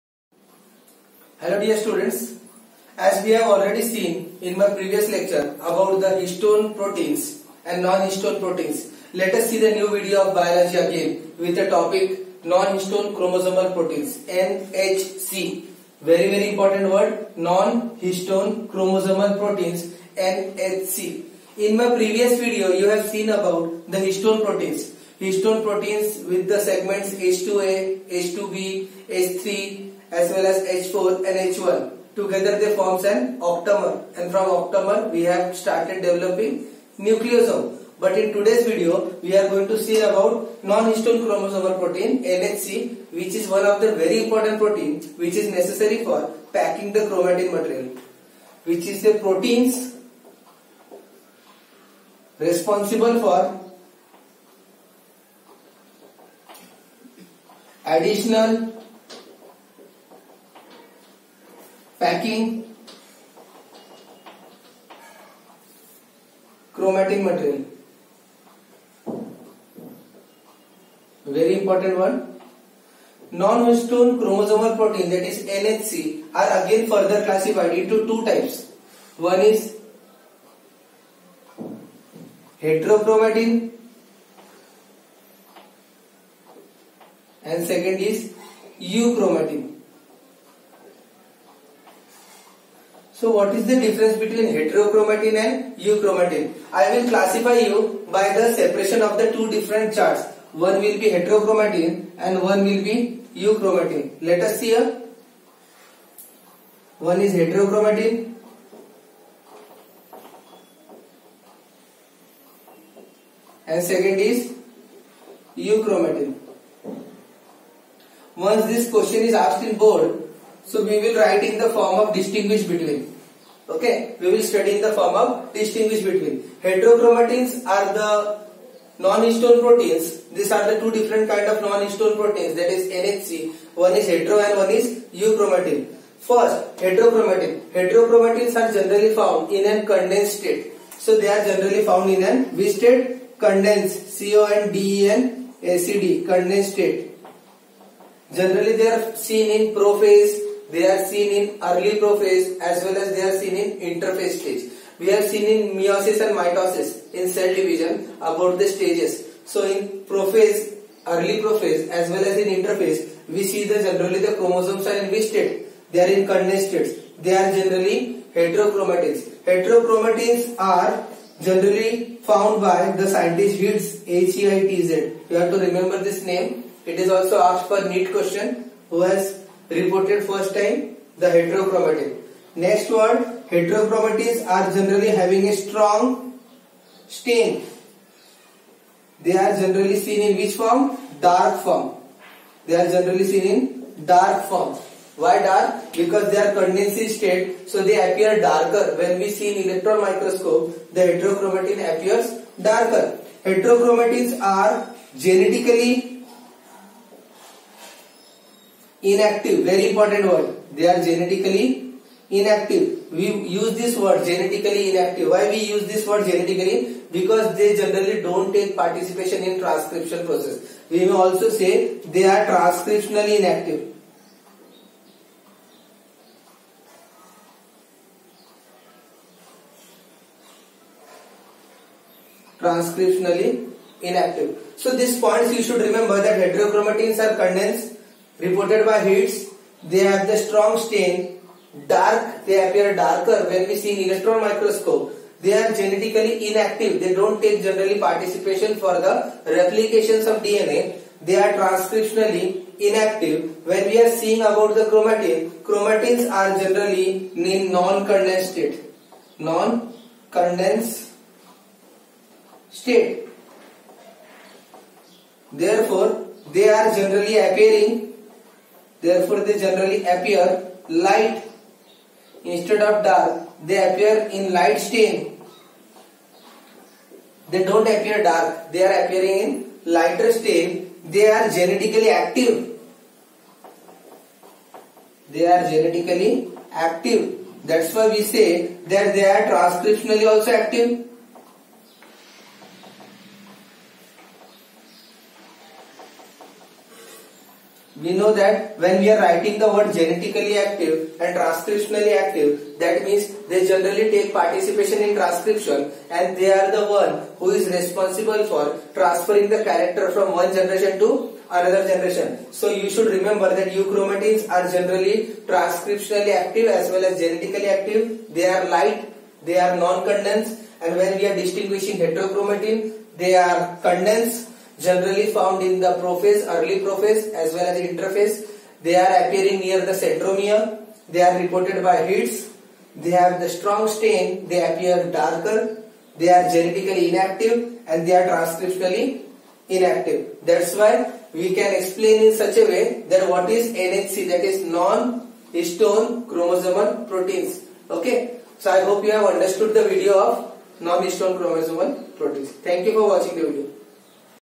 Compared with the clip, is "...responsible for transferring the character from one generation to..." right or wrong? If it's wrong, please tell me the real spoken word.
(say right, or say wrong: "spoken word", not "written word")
right.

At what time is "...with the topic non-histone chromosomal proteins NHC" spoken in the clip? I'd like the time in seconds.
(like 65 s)
11 s.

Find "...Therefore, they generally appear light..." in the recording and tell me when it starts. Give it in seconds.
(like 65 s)
269 s.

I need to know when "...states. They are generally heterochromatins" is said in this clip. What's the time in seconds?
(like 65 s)
166 s.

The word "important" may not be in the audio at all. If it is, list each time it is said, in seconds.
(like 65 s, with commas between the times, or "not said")
16 s, 44 s, 209 s.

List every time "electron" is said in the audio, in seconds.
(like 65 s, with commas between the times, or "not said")
199 s, 244 s.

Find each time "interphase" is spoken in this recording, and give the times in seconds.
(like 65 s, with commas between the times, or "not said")
153 s, 162 s, 327 s.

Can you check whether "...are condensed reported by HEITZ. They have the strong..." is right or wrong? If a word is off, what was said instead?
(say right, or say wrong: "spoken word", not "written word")
wrong: "Higgs", not "HEITZ".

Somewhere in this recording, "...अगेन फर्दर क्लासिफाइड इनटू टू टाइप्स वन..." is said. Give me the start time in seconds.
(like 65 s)
76 s.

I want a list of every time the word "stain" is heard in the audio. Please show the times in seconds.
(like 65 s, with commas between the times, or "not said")
187 s, 240 s, 274 s, 280 s, 333 s.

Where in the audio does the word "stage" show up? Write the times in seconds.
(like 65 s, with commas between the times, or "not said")
154 s, 158 s.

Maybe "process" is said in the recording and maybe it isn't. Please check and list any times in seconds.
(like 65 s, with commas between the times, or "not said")
220 s.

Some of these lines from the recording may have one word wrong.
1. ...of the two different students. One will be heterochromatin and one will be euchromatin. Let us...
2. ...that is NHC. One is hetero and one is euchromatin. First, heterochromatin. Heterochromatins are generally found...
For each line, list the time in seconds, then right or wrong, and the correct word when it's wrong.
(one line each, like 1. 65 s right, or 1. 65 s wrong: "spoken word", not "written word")
1. 99 s wrong: "charts", not "students"
2. 132 s right.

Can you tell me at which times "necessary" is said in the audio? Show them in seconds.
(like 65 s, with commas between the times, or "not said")
45 s.